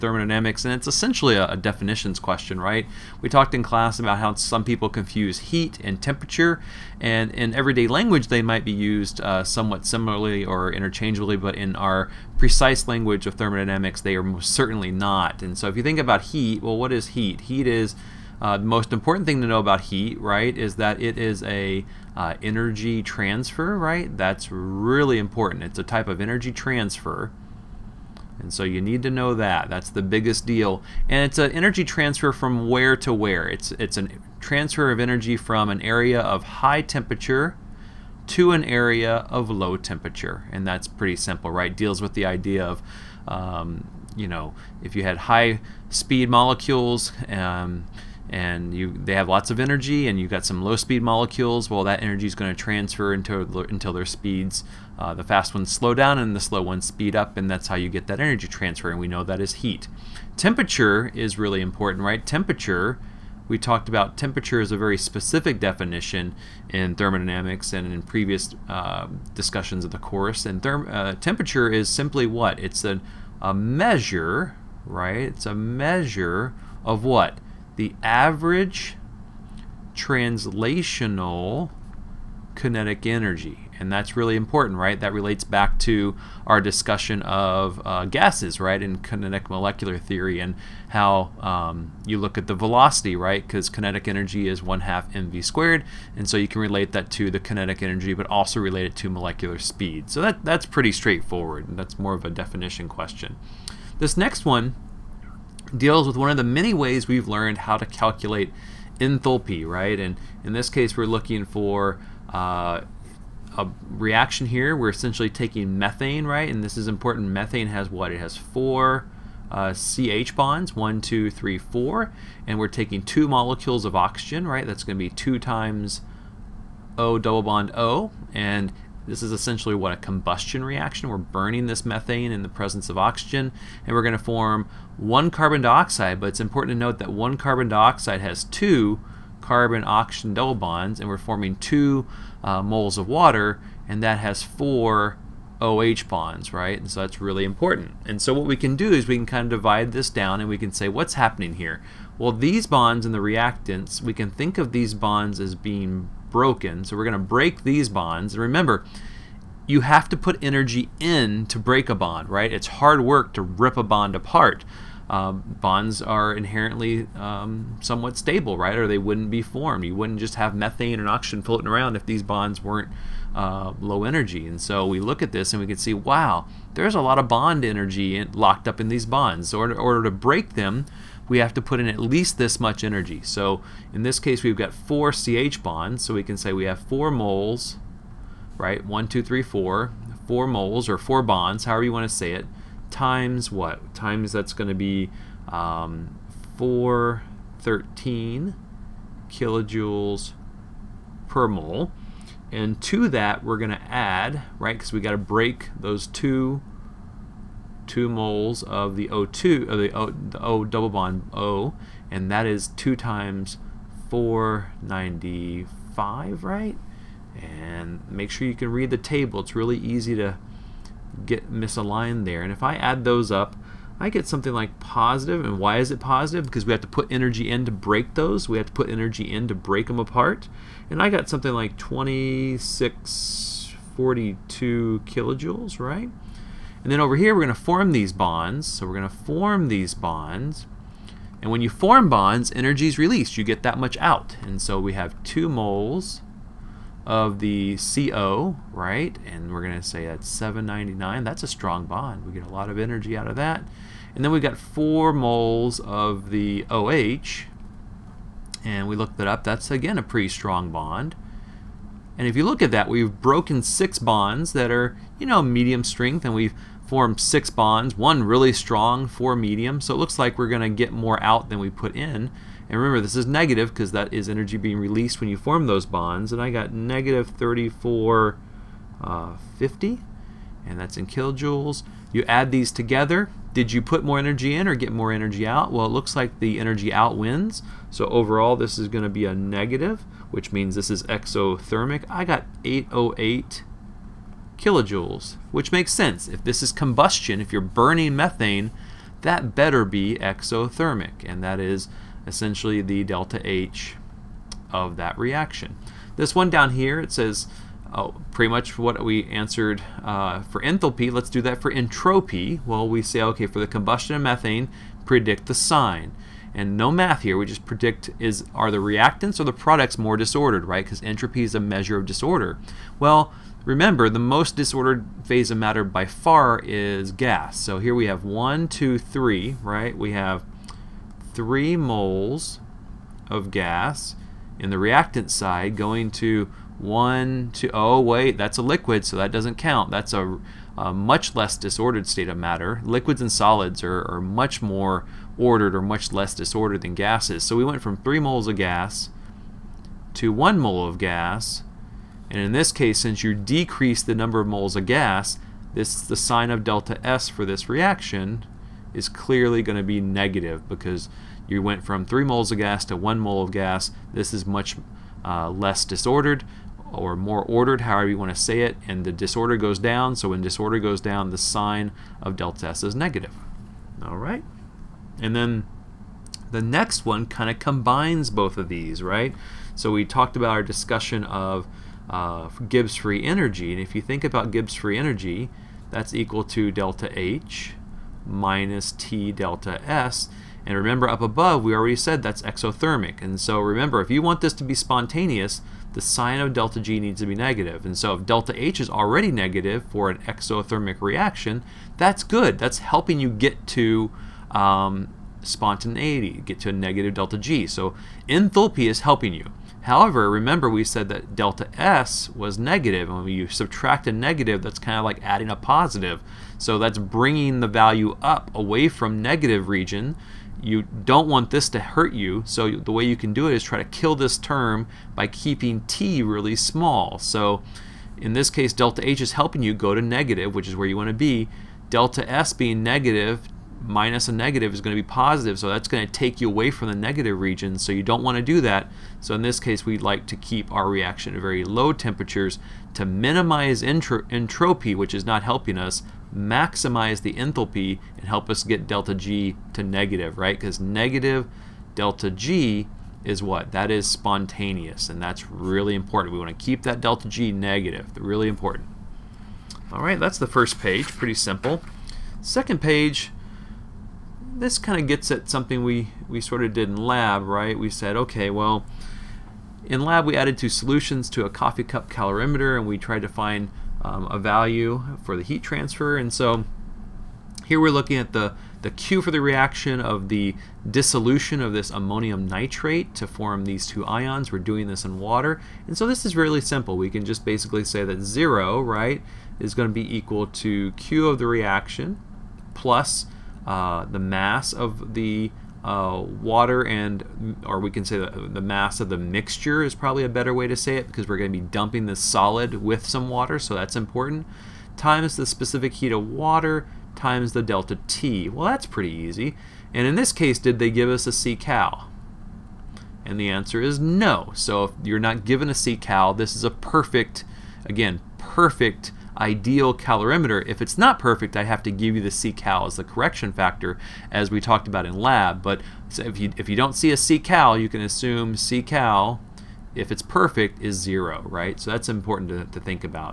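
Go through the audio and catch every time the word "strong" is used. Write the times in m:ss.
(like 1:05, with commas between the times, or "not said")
4:11, 4:20, 4:28.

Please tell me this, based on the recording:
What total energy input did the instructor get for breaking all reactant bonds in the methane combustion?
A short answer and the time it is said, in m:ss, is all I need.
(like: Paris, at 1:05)
2642 kilojoules, at 3:51.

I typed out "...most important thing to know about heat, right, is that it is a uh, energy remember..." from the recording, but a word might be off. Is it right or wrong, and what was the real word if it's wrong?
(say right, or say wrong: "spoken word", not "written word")
wrong: "transfer", not "remember".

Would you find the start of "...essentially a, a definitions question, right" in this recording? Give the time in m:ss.
0:00.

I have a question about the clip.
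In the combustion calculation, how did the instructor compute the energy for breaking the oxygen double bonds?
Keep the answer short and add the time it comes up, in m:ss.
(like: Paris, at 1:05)
2 times 495, at 3:32.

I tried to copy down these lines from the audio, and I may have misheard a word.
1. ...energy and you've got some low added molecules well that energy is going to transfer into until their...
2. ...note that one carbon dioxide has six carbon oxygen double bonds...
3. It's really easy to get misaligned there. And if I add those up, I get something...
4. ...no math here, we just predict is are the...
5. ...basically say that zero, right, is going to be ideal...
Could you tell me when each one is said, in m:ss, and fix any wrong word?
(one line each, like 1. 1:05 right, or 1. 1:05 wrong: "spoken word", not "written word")
1. 0:49 wrong: "speed", not "added"
2. 2:16 wrong: "two", not "six"
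3. 3:39 right
4. 5:16 right
5. 8:07 wrong: "equal", not "ideal".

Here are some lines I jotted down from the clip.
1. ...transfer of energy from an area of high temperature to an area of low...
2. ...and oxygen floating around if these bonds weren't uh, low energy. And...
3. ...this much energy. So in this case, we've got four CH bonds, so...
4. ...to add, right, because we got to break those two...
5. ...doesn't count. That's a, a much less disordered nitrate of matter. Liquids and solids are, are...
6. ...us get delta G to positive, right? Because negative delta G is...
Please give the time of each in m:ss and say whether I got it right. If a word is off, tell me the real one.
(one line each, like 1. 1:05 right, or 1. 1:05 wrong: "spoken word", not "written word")
1. 0:34 right
2. 2:50 right
3. 3:02 right
4. 3:23 right
5. 5:39 wrong: "state", not "nitrate"
6. 7:28 wrong: "negative", not "positive".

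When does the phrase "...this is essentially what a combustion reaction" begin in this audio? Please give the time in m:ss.
2:09.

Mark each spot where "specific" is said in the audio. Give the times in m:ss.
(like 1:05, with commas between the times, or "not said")
1:04, 8:25.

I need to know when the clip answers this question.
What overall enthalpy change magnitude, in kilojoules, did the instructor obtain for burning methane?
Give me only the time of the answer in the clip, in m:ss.
4:52.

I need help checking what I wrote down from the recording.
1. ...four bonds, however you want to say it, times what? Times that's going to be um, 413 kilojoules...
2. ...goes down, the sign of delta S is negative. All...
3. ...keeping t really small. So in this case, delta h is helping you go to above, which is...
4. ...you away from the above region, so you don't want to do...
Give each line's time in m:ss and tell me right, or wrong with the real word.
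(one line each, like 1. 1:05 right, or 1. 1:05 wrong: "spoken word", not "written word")
1. 3:10 right
2. 6:10 right
3. 7:05 wrong: "negative", not "above"
4. 7:16 wrong: "negative", not "above".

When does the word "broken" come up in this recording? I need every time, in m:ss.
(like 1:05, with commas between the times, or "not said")
2:36, 4:23.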